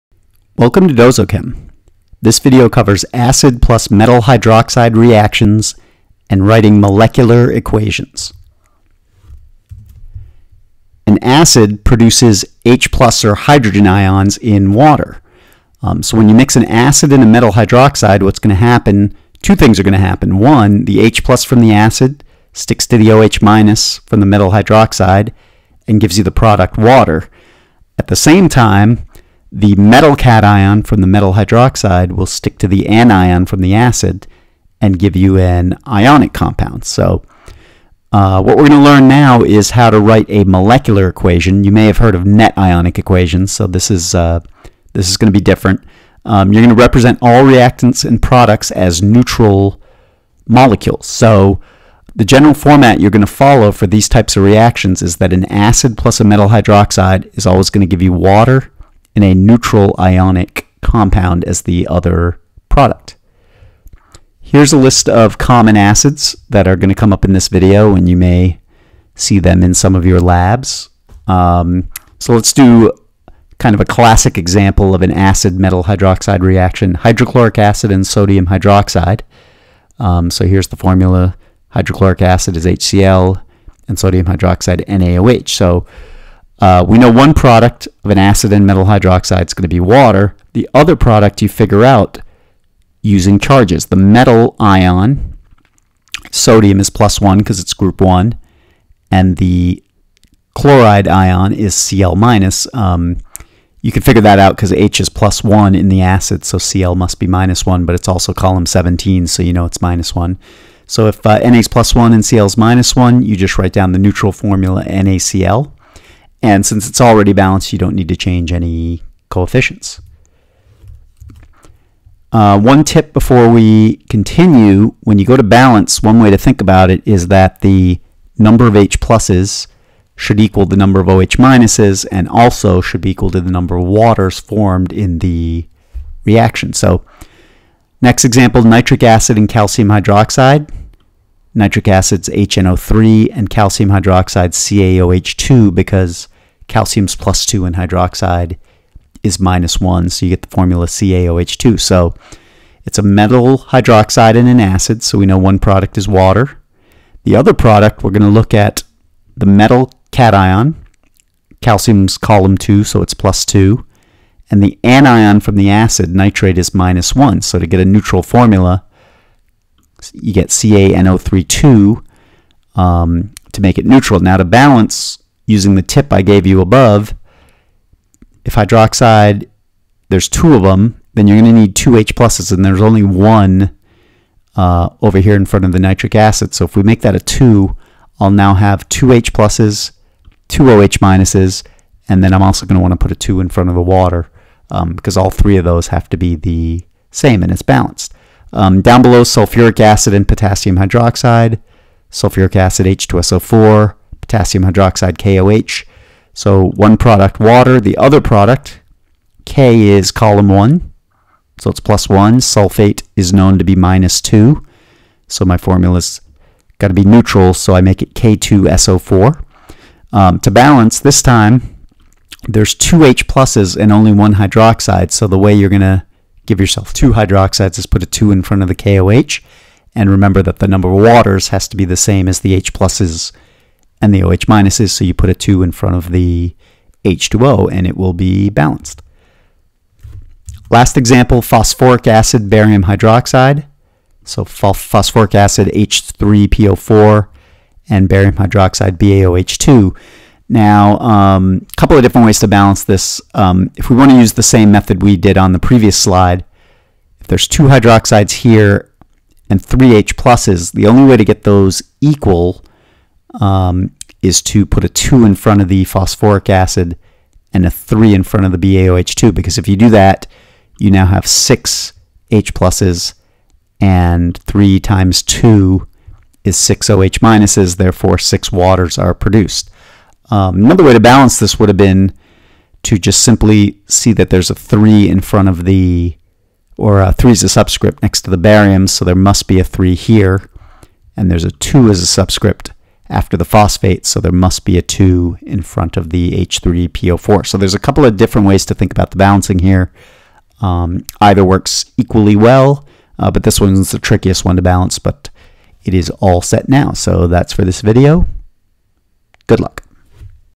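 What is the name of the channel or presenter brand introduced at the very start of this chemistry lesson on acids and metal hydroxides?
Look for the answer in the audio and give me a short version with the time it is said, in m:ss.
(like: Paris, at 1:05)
Dozochem, at 0:00.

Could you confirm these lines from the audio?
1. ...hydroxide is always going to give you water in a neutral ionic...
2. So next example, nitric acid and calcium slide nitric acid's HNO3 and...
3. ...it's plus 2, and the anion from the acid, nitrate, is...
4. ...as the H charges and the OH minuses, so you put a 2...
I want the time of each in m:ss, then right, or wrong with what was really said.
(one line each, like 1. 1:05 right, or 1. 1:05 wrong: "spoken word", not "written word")
1. 0:56 right
2. 2:16 wrong: "hydroxide", not "slide"
3. 2:43 right
4. 3:52 wrong: "pluses", not "charges".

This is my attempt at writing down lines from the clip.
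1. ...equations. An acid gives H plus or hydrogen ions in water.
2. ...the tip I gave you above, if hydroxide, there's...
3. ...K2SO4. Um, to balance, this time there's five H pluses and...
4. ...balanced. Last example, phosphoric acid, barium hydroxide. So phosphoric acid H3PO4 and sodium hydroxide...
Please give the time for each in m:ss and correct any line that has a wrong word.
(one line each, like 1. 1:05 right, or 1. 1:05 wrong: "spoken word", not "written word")
1. 0:07 wrong: "produces", not "gives"
2. 2:55 right
3. 3:38 wrong: "two", not "five"
4. 3:58 wrong: "barium", not "sodium".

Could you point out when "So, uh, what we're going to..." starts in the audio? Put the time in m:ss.
0:36.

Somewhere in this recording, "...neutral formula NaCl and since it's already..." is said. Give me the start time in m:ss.
1:53.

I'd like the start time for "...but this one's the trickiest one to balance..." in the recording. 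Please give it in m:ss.
5:03.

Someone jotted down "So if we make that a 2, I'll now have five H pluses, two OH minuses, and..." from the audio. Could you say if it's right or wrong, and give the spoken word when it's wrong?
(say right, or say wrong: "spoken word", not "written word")
wrong: "two", not "five".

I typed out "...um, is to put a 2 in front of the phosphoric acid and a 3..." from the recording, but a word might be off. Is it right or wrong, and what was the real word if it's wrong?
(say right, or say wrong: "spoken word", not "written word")
right.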